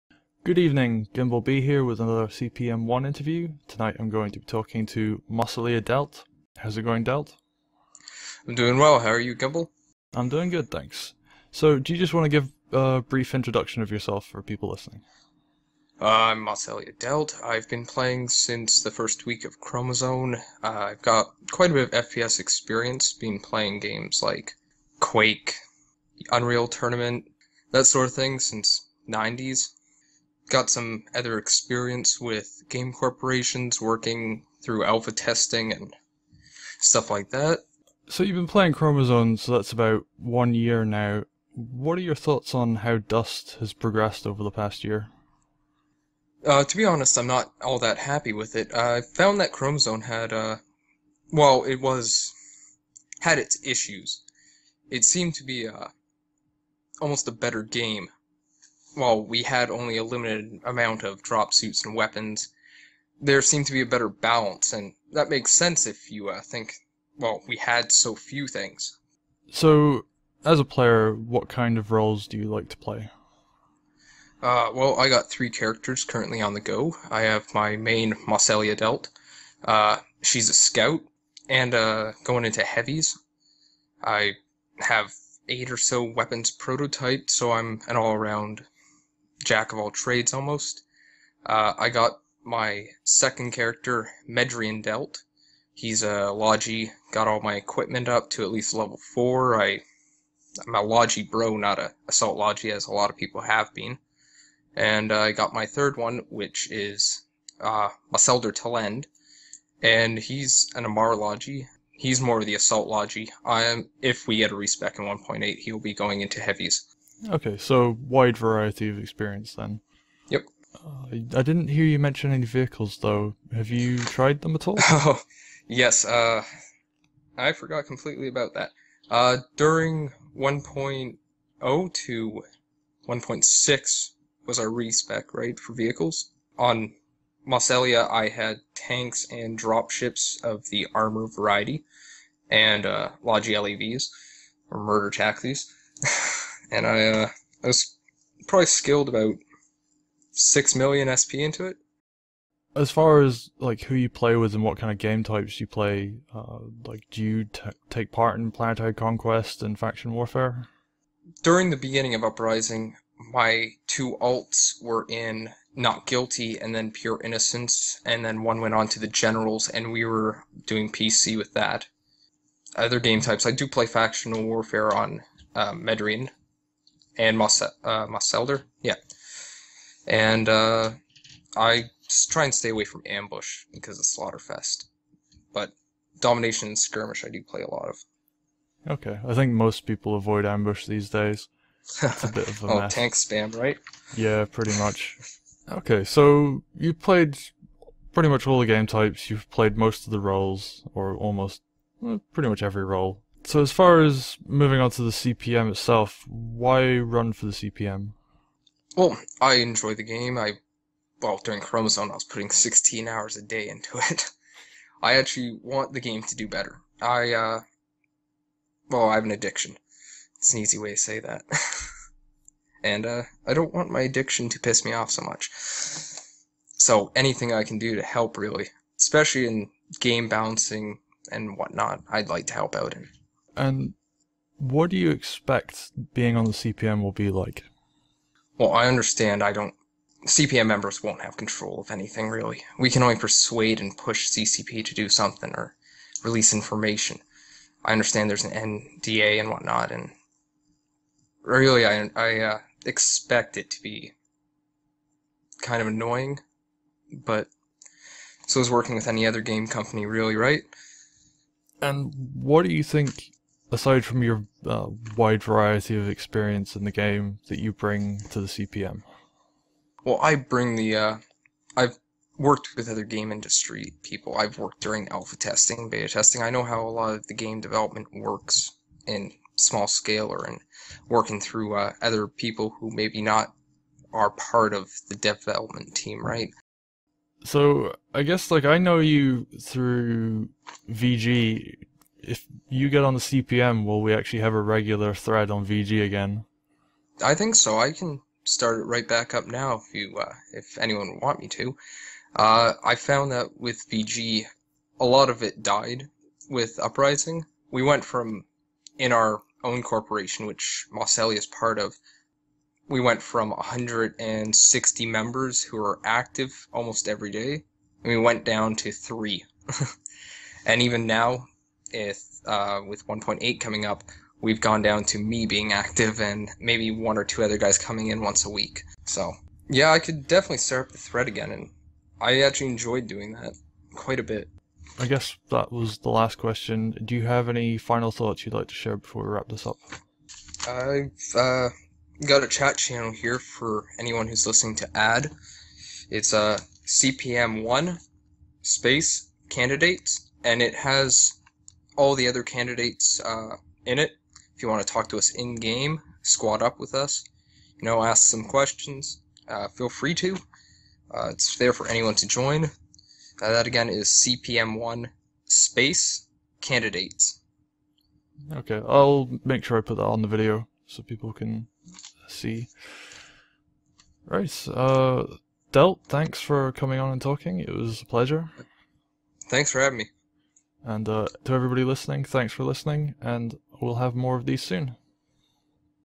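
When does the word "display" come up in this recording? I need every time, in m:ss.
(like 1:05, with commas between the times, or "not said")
not said.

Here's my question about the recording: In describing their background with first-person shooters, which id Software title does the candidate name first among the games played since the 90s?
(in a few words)
Quake.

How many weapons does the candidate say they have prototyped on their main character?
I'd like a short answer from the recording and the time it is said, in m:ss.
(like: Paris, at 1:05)
8, at 1:25.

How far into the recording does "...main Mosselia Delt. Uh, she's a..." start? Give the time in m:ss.
1:17.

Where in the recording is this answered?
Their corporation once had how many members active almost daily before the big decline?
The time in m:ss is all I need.
5:13.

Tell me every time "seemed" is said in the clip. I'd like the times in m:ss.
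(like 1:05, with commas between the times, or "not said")
0:55, 1:03.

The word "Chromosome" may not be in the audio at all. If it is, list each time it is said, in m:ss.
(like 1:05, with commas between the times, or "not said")
0:19, 0:38, 0:49, 3:31.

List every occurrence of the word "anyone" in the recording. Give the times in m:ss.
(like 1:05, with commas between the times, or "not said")
5:00, 5:43, 6:01.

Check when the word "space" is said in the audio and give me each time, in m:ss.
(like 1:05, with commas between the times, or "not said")
5:48, 6:05.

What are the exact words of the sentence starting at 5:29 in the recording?
So yeah, I could definitely start up the thread again, and I actually enjoyed doing that quite a bit.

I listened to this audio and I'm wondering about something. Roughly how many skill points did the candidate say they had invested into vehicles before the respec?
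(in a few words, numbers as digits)
6 million.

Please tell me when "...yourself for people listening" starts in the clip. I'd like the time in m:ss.
0:13.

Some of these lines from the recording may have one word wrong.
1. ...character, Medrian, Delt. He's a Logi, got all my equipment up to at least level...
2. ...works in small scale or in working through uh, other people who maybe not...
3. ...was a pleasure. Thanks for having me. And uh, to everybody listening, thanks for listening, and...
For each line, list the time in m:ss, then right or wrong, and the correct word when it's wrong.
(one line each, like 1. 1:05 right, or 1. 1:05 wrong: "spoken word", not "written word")
1. 1:33 right
2. 4:38 right
3. 6:17 right.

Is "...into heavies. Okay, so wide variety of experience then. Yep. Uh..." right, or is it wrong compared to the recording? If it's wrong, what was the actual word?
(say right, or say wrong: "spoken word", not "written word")
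right.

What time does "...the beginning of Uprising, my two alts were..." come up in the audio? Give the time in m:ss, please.
2:41.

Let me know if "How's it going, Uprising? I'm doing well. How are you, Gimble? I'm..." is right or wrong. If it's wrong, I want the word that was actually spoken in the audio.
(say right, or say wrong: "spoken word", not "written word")
wrong: "Delt", not "Uprising".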